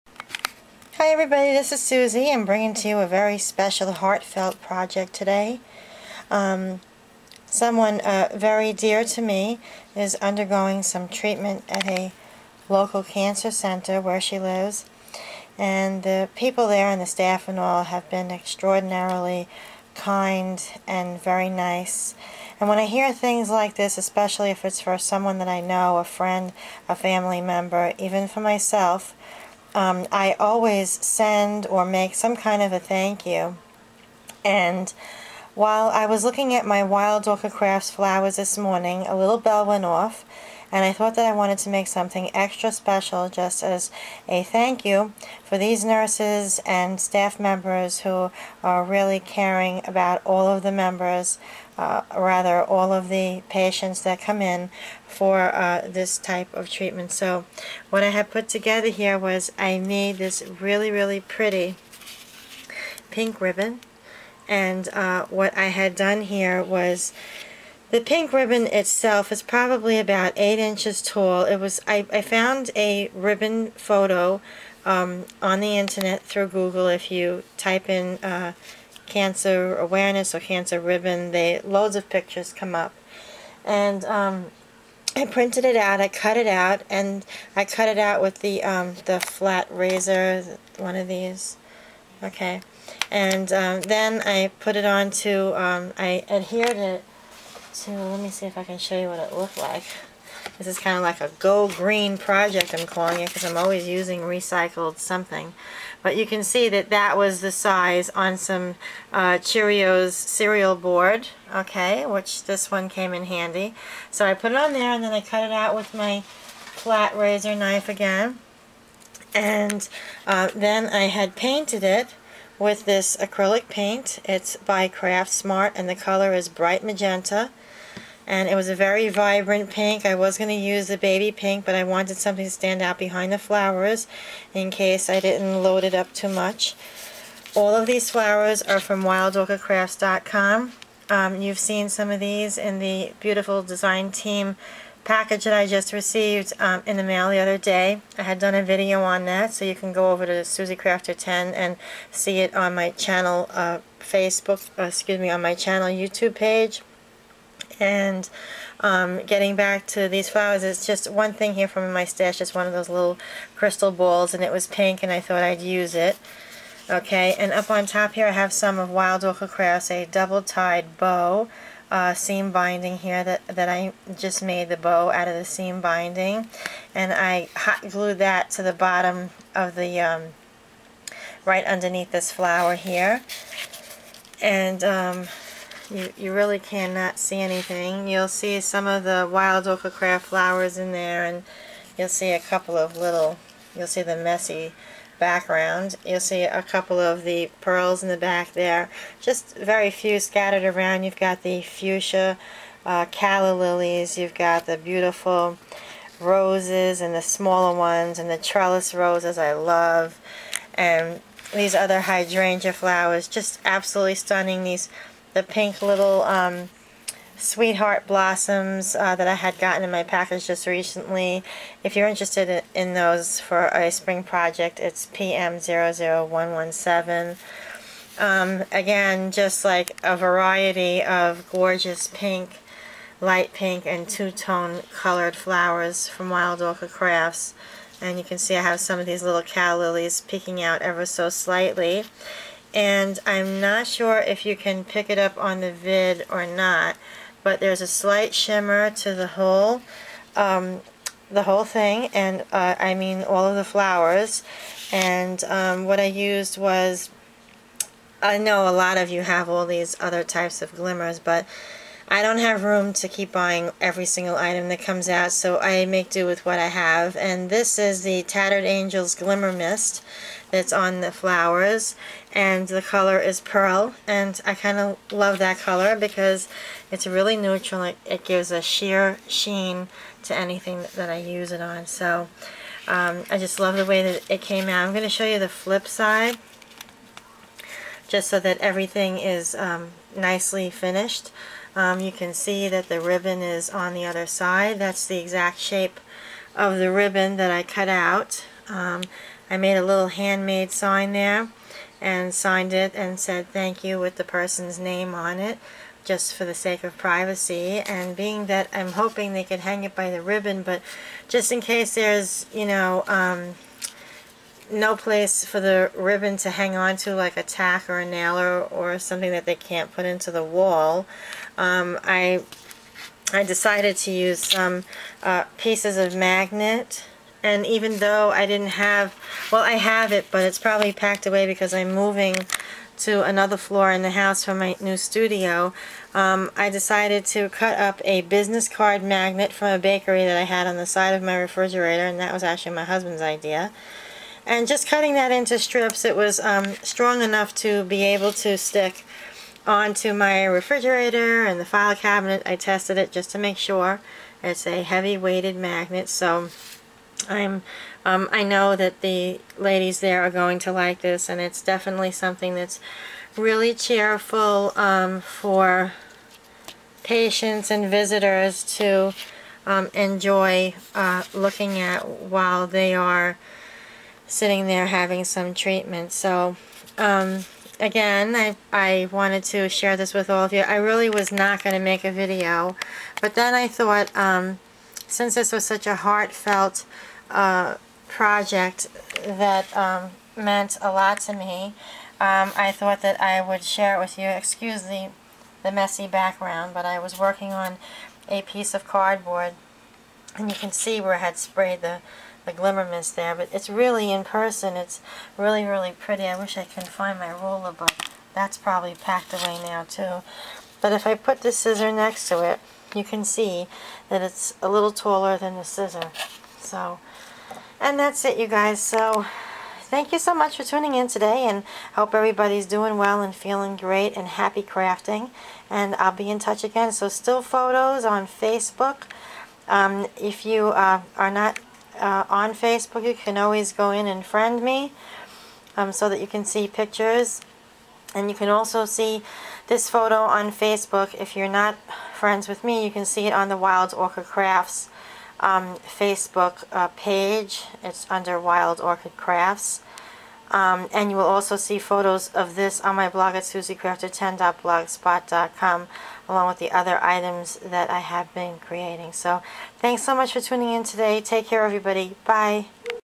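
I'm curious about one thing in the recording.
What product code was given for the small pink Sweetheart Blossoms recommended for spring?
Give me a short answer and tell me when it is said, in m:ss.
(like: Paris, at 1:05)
PM00117, at 3:45.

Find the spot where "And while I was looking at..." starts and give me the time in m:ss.
0:34.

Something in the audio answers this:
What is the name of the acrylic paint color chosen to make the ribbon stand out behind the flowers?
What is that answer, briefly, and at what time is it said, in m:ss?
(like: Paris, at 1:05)
bright magenta, at 2:06.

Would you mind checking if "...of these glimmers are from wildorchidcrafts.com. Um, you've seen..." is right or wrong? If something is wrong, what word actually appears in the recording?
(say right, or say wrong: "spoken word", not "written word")
wrong: "flowers", not "glimmers".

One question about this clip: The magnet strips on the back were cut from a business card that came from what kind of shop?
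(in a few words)
a bakery.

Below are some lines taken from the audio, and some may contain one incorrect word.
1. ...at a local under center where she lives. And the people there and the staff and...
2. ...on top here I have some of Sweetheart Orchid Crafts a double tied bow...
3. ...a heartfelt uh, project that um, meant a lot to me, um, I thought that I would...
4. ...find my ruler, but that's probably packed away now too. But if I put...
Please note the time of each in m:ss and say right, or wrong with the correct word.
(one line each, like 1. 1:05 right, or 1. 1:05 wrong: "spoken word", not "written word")
1. 0:11 wrong: "cancer", not "under"
2. 2:47 wrong: "Wild", not "Sweetheart"
3. 6:25 right
4. 6:46 right.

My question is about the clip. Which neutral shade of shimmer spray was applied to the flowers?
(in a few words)
pearl.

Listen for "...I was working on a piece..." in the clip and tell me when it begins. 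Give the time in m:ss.
6:36.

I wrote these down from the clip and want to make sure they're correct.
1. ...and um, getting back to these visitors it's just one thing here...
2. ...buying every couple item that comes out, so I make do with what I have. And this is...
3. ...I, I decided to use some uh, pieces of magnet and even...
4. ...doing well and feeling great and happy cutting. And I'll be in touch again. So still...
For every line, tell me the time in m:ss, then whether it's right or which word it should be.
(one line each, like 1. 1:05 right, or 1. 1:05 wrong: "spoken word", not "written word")
1. 2:37 wrong: "flowers", not "visitors"
2. 4:23 wrong: "single", not "couple"
3. 5:22 right
4. 7:02 wrong: "crafting", not "cutting".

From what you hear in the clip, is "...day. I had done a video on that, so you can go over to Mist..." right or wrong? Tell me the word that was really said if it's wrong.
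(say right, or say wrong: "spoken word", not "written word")
wrong: "Suzie", not "Mist".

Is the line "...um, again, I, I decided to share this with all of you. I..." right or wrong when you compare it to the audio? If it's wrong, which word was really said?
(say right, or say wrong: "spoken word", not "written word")
wrong: "wanted", not "decided".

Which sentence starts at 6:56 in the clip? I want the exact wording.
So, and that's it you guys.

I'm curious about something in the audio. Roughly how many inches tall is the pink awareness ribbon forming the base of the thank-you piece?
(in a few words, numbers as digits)
8 inches.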